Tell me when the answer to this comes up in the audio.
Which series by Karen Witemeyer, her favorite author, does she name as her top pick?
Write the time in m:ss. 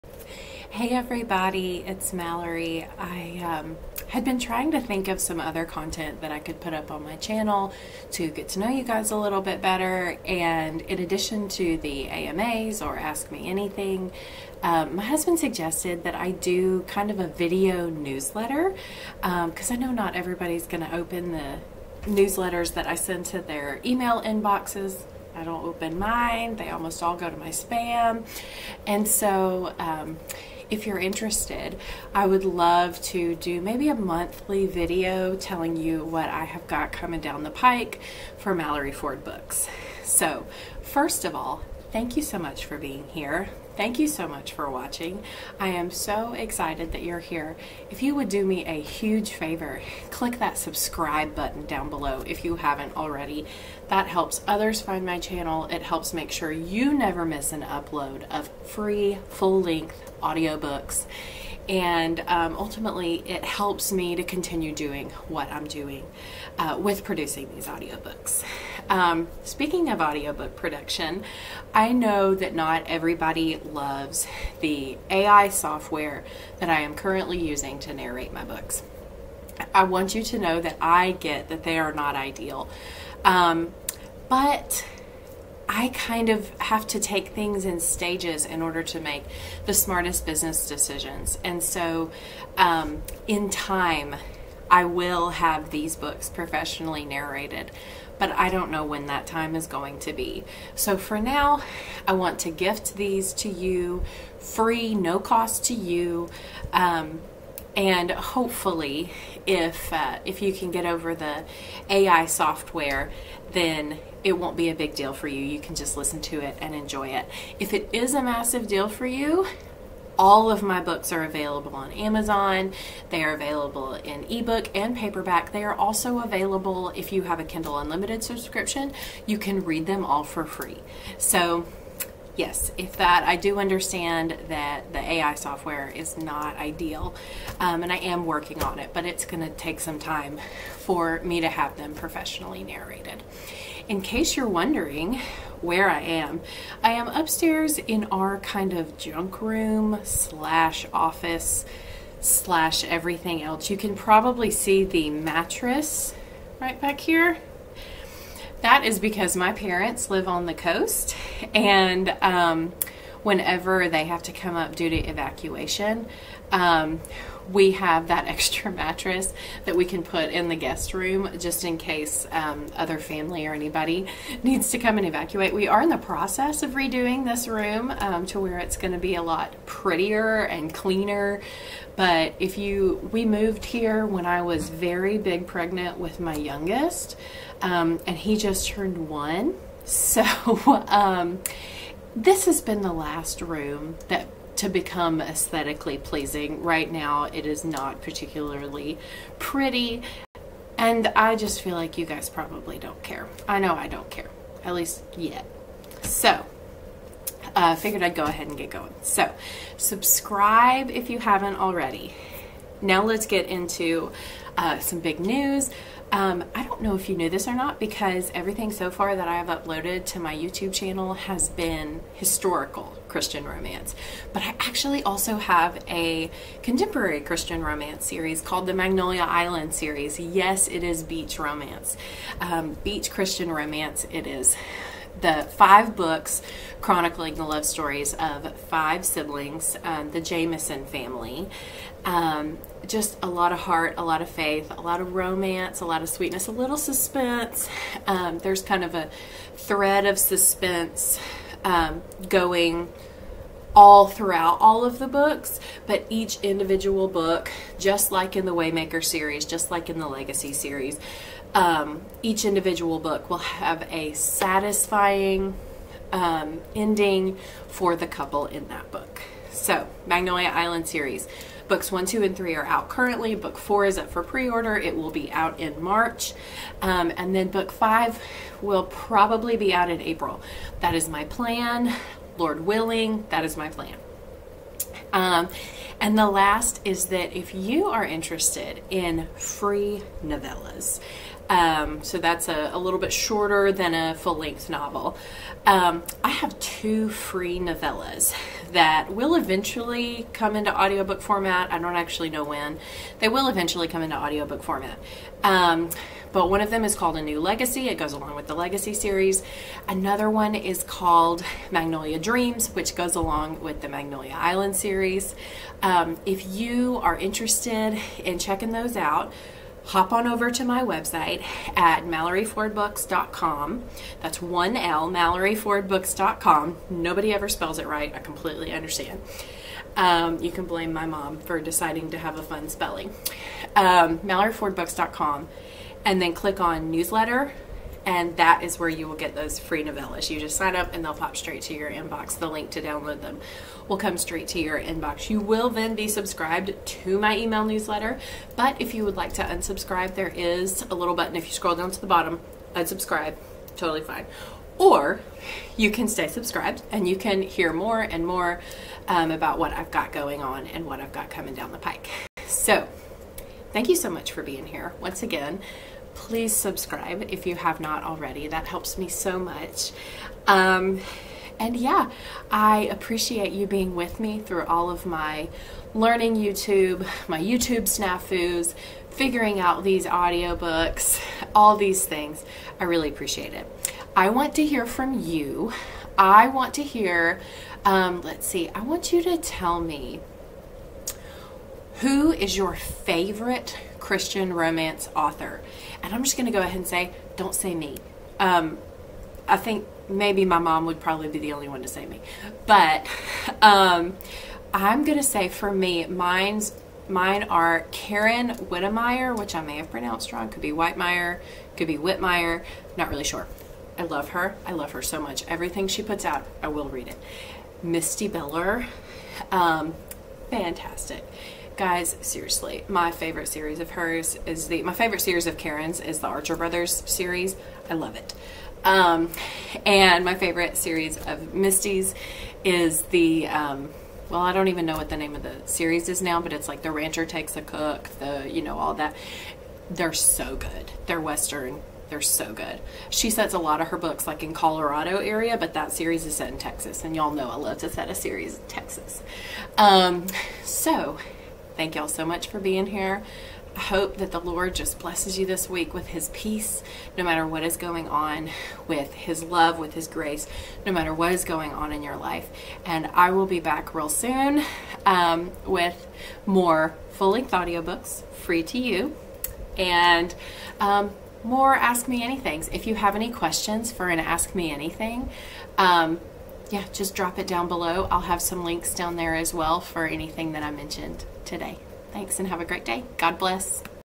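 7:06.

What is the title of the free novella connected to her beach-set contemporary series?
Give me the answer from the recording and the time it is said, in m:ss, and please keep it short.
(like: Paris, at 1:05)
Magnolia Dreams, at 5:11.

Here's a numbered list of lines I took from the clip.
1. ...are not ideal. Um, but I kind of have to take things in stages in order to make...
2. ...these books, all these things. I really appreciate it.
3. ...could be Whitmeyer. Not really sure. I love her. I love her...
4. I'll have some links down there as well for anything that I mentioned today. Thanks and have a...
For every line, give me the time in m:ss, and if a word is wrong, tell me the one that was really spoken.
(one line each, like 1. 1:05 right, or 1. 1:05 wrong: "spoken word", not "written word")
1. 1:21 right
2. 6:19 wrong: "audiobooks", not "books"
3. 6:51 right
4. 7:58 right.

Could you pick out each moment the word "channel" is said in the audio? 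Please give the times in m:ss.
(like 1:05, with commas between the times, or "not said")
0:07, 0:55, 3:40.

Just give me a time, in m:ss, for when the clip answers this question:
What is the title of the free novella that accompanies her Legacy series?
5:07.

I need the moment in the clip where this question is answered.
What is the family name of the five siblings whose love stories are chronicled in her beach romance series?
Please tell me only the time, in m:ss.
4:00.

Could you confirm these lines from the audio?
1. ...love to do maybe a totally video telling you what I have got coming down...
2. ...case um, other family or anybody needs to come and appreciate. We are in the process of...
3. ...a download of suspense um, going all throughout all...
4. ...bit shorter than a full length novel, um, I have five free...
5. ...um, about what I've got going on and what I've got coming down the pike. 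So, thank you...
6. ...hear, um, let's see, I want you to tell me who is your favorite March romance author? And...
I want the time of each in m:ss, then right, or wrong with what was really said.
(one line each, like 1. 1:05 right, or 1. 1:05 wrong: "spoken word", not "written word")
1. 0:32 wrong: "monthly", not "totally"
2. 2:51 wrong: "evacuate", not "appreciate"
3. 4:08 wrong: "thread", not "download"
4. 4:52 wrong: "two", not "five"
5. 5:59 right
6. 6:26 wrong: "Christian", not "March".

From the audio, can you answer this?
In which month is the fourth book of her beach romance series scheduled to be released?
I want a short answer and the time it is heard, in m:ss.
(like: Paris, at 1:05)
March, at 4:35.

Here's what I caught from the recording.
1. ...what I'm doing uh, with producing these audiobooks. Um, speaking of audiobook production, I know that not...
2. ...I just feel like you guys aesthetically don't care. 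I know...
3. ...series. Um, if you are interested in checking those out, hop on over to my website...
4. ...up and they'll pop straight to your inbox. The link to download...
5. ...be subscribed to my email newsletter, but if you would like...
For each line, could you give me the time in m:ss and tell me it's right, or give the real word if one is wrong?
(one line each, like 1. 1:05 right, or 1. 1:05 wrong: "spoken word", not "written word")
1. 1:05 right
2. 3:21 wrong: "probably", not "aesthetically"
3. 5:14 right
4. 5:40 right
5. 5:45 right.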